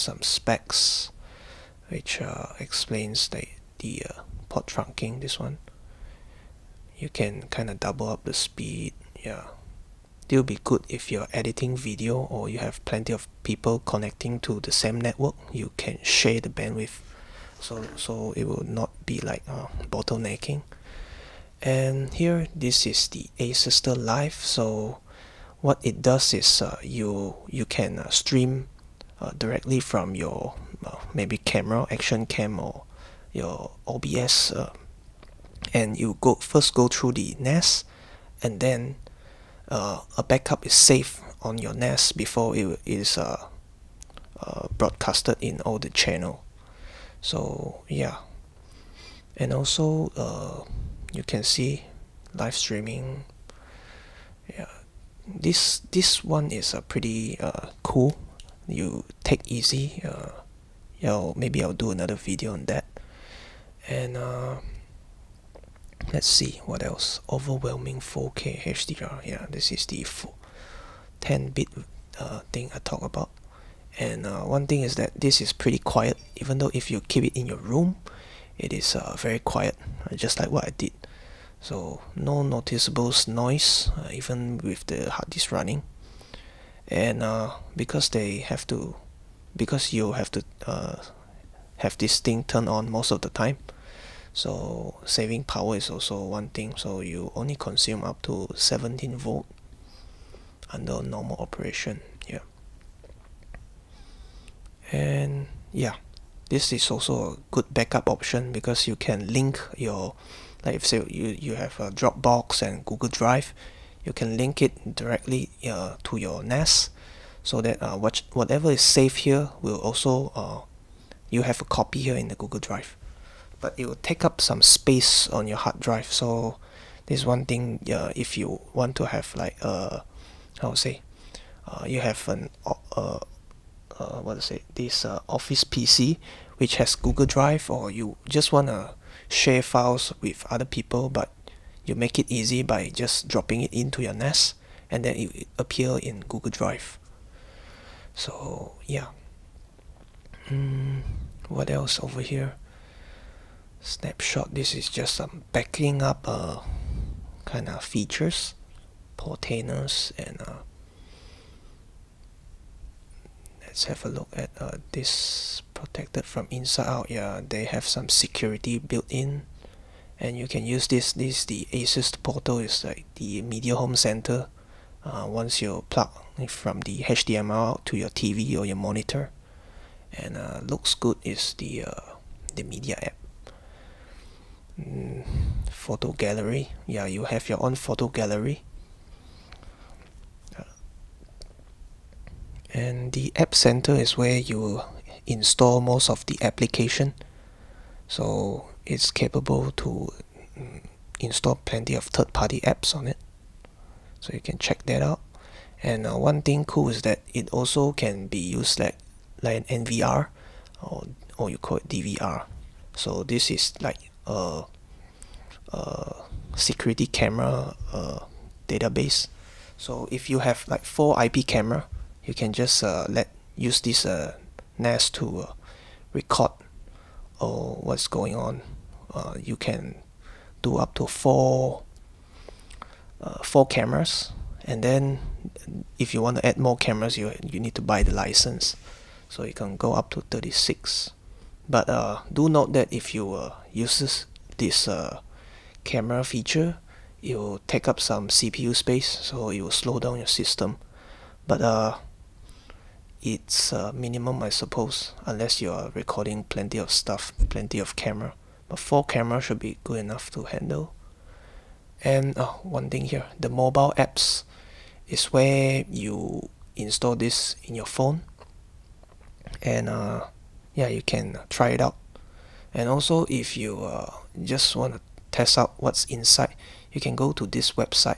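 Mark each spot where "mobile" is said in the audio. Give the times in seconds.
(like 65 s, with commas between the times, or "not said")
263 s.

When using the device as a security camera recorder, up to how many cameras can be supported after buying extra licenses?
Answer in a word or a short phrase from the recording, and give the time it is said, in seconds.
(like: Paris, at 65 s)
36, at 240 s.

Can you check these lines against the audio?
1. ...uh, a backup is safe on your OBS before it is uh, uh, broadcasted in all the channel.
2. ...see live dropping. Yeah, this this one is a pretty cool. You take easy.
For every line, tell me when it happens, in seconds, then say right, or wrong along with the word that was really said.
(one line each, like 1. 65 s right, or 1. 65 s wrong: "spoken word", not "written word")
1. 39 s wrong: "NAS", not "OBS"
2. 51 s wrong: "streaming", not "dropping".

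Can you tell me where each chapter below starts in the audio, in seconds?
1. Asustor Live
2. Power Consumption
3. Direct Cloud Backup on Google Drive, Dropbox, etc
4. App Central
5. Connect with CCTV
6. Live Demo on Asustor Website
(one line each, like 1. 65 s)
1. 22 s
2. 85 s
3. 109 s
4. 191 s
5. 205 s
6. 269 s.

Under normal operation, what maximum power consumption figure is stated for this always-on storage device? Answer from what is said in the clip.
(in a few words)
17 volt.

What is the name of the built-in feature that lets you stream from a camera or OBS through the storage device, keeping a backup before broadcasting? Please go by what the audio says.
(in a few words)
Asustor Live.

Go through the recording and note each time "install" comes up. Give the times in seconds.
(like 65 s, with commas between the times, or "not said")
195 s, 201 s, 266 s.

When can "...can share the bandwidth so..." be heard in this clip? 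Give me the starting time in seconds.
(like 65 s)
15 s.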